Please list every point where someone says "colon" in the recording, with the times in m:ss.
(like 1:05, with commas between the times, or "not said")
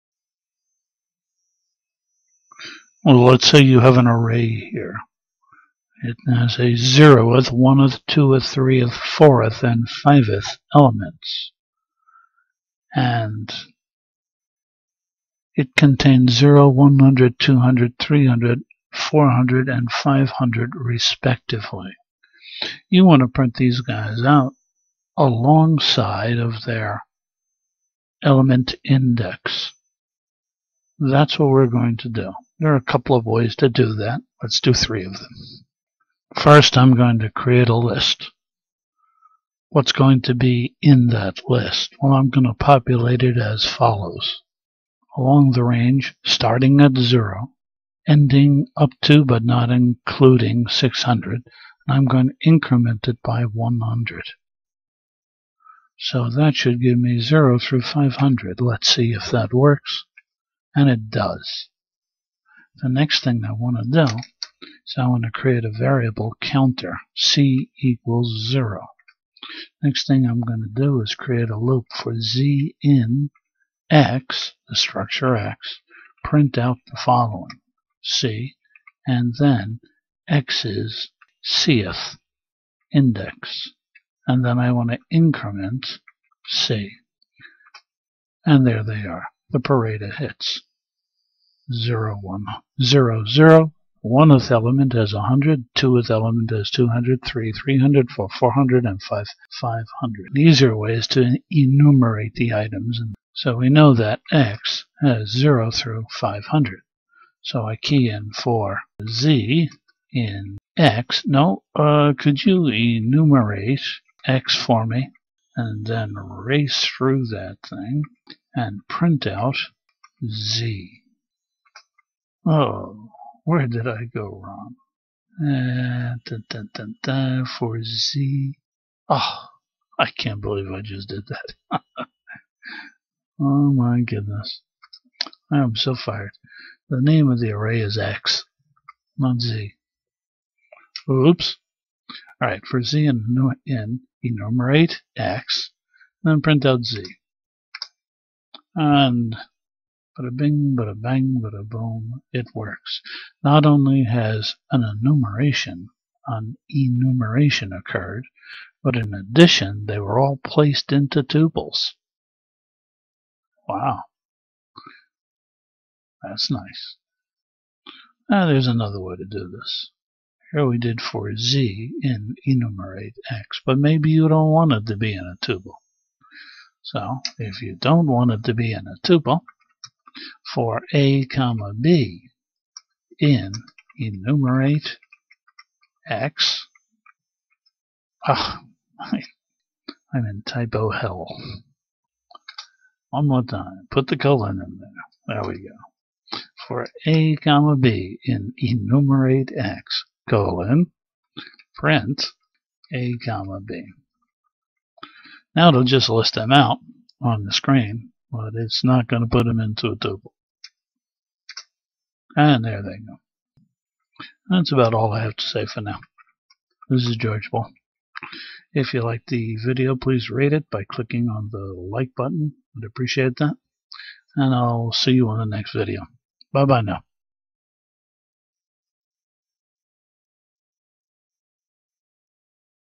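3:14, 3:20.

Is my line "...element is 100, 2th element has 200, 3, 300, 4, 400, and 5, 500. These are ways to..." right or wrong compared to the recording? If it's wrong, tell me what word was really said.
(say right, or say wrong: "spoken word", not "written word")
right.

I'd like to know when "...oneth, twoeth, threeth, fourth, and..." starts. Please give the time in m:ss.
0:07.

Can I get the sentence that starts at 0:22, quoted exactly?
You want to print these guys out alongside of their element index.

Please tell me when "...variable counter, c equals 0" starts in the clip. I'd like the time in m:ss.
1:05.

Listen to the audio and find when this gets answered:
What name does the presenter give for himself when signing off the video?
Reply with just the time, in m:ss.
3:37.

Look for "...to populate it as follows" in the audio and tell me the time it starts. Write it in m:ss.
0:42.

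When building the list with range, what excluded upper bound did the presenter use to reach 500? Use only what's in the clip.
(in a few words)
600.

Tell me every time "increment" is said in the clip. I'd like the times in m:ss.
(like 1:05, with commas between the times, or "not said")
0:52, 1:25.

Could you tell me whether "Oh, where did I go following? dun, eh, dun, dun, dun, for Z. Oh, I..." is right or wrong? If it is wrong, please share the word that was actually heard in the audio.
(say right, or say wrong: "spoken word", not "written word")
wrong: "wrong", not "following".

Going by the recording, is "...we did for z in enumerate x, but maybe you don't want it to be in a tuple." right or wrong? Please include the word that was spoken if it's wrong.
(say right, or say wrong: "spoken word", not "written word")
right.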